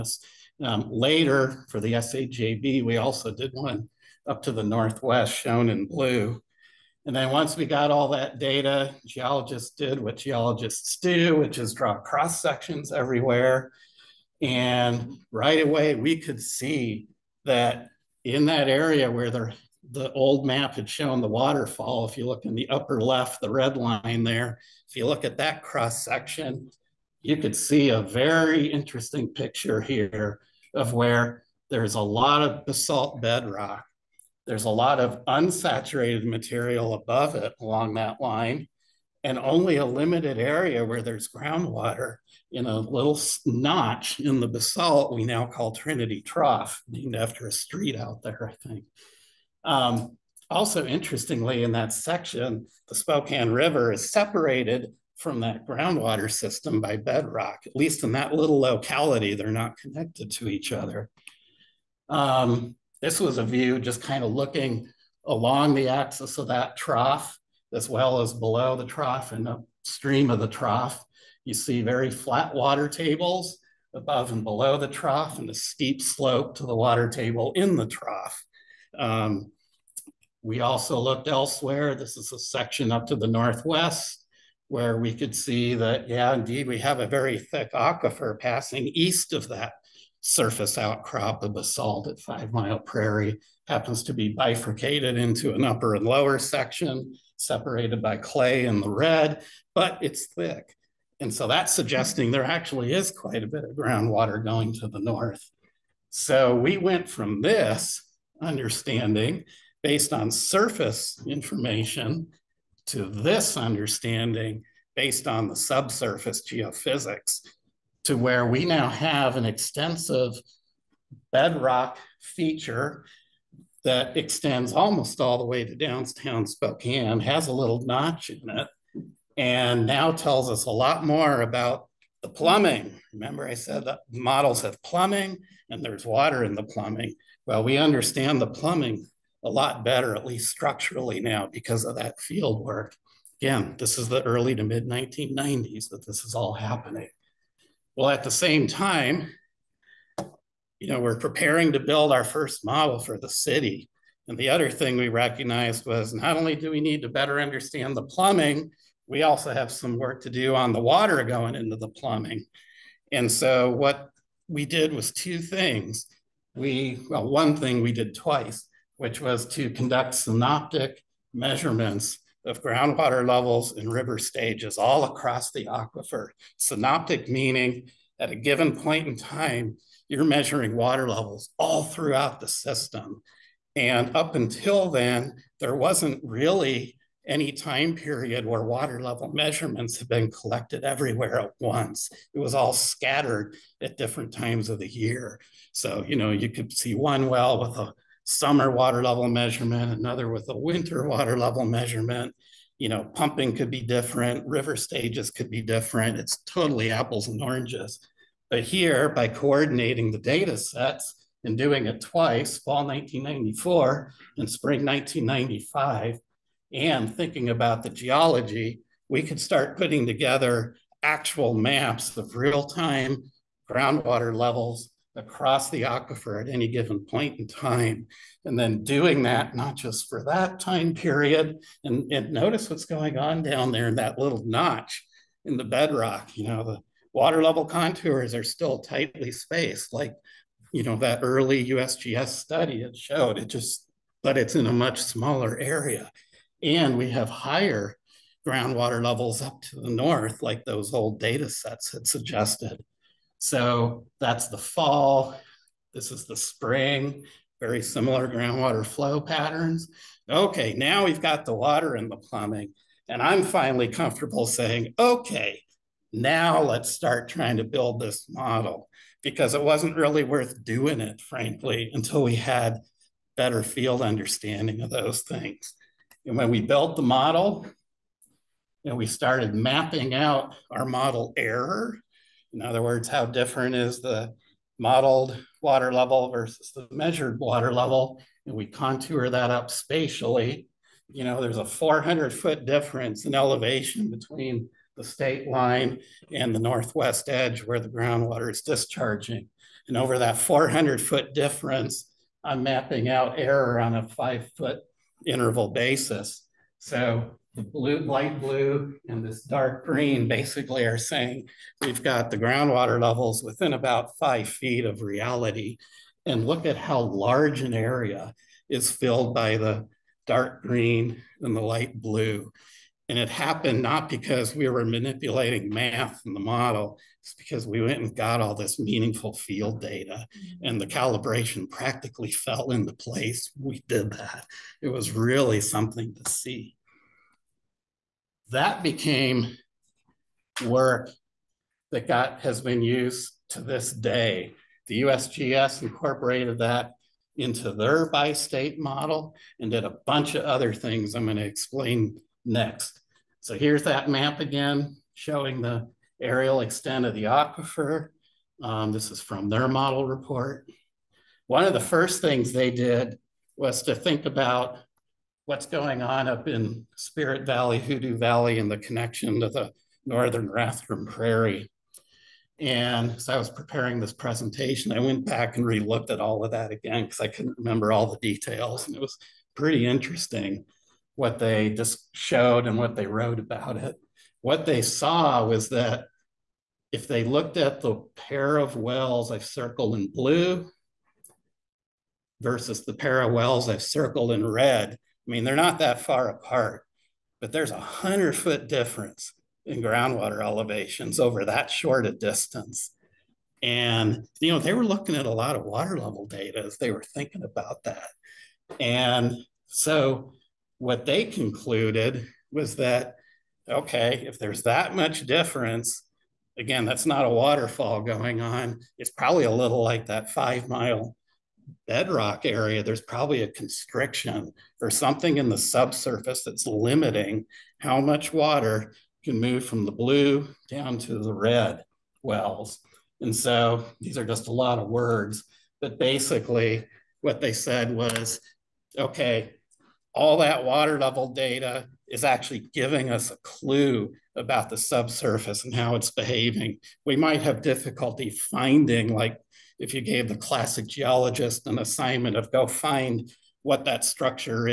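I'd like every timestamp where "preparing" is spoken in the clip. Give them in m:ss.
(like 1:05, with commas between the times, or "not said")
2:31, 6:13.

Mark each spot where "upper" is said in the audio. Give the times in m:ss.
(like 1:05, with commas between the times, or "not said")
0:22, 1:35.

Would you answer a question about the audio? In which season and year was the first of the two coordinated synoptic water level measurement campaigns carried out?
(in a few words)
Fall 1994.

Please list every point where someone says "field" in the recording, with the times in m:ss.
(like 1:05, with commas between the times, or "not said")
2:22, 4:33, 5:29.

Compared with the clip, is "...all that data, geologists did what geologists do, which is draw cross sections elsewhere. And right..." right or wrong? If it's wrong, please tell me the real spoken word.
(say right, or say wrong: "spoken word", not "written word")
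wrong: "everywhere", not "elsewhere".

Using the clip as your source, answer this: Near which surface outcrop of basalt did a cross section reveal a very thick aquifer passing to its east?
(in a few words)
Five Mile Prairie.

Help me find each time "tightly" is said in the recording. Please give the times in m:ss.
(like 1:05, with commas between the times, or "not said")
3:58.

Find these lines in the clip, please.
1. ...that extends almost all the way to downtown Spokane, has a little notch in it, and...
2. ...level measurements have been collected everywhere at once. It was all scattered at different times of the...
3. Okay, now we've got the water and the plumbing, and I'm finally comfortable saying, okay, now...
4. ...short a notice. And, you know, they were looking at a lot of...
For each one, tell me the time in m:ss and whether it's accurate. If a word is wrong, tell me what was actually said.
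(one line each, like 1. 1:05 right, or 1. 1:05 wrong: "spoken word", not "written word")
1. 2:03 right
2. 3:09 right
3. 4:20 right
4. 6:41 wrong: "distance", not "notice".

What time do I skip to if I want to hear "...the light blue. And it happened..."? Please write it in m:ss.
5:21.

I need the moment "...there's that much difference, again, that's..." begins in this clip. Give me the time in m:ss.
6:54.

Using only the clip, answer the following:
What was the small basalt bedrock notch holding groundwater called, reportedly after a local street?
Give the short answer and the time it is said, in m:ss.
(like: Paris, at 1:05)
Trinity Trough, at 0:45.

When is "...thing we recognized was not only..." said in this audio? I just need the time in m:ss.
2:34.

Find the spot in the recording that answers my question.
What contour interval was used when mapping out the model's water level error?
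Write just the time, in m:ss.
5:04.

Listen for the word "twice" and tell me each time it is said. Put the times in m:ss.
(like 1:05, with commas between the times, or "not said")
2:48, 3:32.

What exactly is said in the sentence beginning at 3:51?
And, and notice what's going on down there in that little notch in the bedrock.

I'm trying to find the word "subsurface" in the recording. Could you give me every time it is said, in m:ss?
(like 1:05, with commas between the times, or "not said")
1:55, 7:05, 7:24.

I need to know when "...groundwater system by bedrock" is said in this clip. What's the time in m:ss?
0:55.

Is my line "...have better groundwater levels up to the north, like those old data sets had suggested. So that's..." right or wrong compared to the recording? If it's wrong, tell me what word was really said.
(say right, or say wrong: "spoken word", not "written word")
wrong: "higher", not "better".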